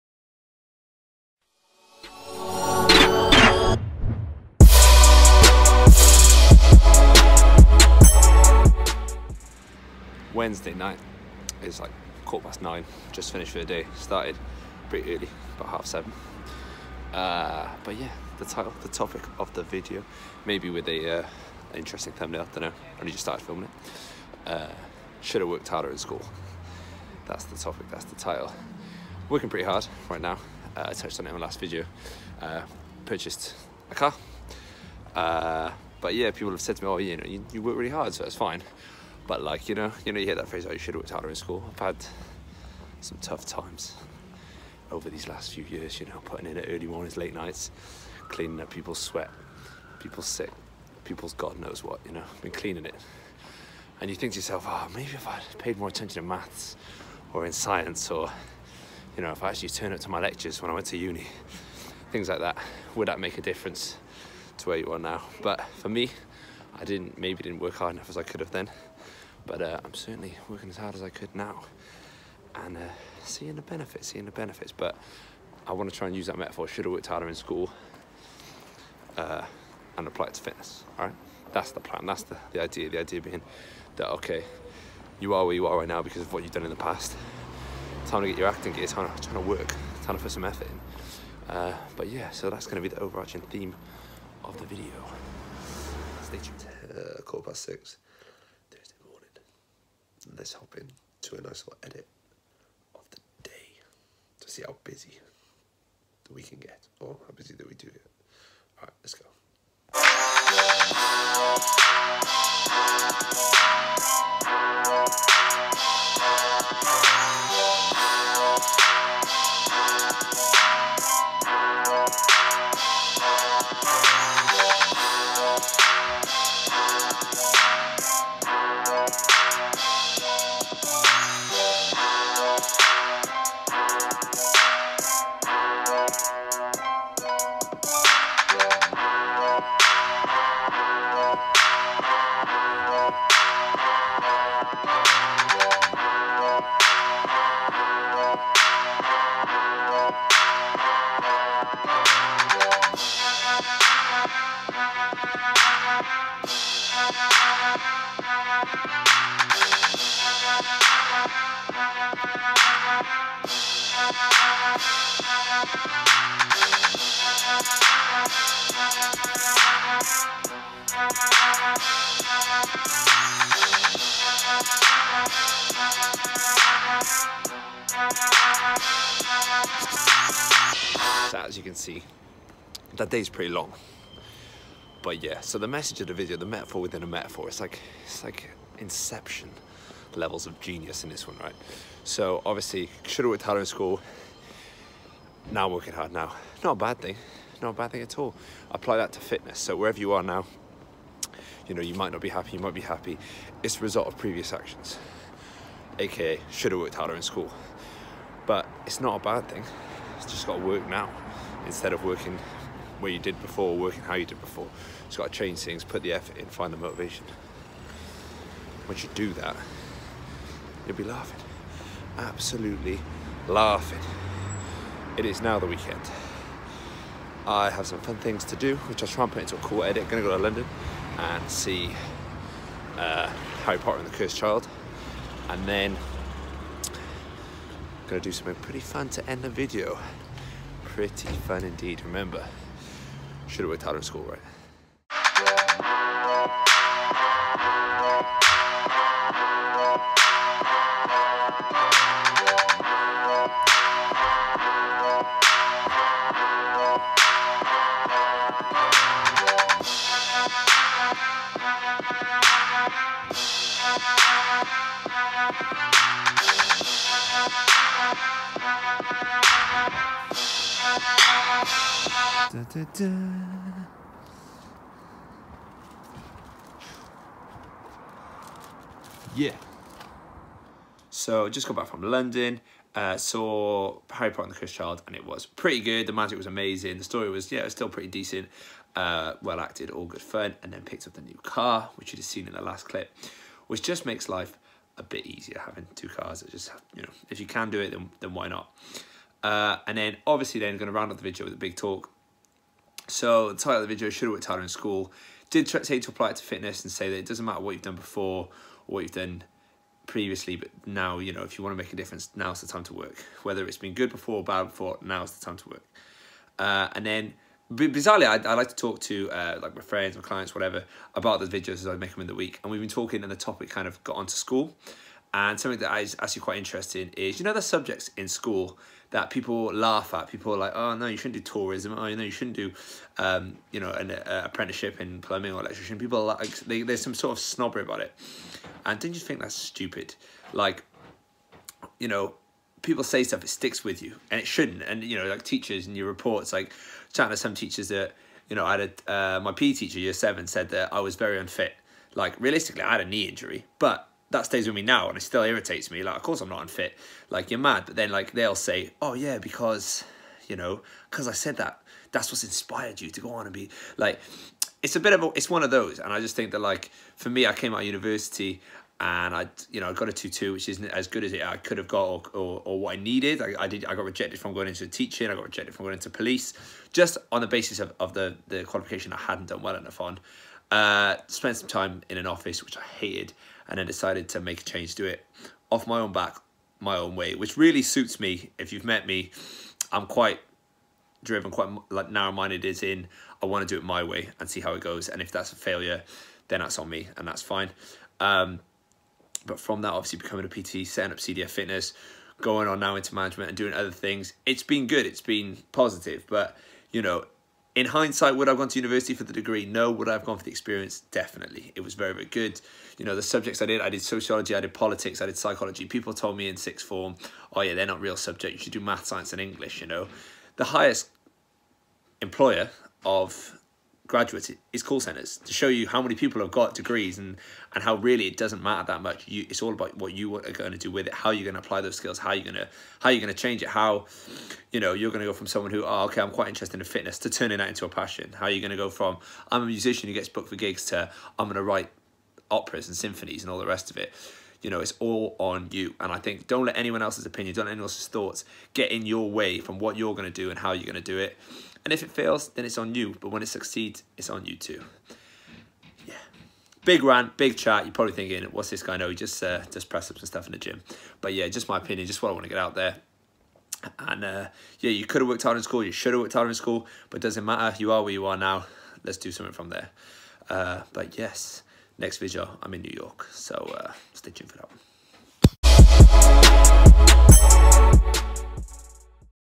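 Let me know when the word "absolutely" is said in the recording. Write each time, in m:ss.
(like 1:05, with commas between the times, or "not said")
3:42.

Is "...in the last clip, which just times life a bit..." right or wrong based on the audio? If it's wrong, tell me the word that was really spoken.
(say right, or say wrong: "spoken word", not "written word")
wrong: "makes", not "times".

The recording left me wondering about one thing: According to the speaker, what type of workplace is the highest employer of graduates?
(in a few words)
call centers.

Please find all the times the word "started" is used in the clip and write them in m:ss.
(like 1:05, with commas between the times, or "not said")
0:13, 0:23.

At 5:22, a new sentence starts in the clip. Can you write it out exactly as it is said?
And we've been talking, and the topic kind of got onto school.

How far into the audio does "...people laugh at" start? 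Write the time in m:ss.
5:29.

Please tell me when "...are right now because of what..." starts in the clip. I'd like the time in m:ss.
1:25.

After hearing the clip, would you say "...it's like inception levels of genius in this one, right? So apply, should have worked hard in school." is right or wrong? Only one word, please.
wrong.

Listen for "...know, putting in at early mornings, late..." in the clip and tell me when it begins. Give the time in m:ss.
0:46.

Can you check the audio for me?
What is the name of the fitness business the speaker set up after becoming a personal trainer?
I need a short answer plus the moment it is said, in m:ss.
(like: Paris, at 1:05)
CDF Fitness, at 6:41.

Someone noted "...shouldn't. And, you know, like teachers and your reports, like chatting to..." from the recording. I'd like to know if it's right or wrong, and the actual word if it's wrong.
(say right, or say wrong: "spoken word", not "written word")
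right.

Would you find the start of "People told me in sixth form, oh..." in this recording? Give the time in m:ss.
6:55.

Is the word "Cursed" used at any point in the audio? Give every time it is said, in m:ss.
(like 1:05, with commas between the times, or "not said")
3:54, 4:44.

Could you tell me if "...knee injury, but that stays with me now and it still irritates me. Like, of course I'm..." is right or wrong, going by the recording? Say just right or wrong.
right.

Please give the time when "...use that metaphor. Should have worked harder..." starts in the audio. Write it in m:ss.
1:16.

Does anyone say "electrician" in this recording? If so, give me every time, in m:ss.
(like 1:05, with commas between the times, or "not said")
5:35.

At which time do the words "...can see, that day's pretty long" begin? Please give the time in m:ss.
3:01.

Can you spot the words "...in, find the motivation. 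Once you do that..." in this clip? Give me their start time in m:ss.
3:36.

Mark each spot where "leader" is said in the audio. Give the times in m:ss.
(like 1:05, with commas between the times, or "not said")
not said.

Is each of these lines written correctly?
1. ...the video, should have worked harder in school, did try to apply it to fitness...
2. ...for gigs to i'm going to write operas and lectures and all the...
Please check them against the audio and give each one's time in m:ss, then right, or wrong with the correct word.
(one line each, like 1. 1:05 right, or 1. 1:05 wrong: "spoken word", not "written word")
1. 5:03 right
2. 7:20 wrong: "symphonies", not "lectures".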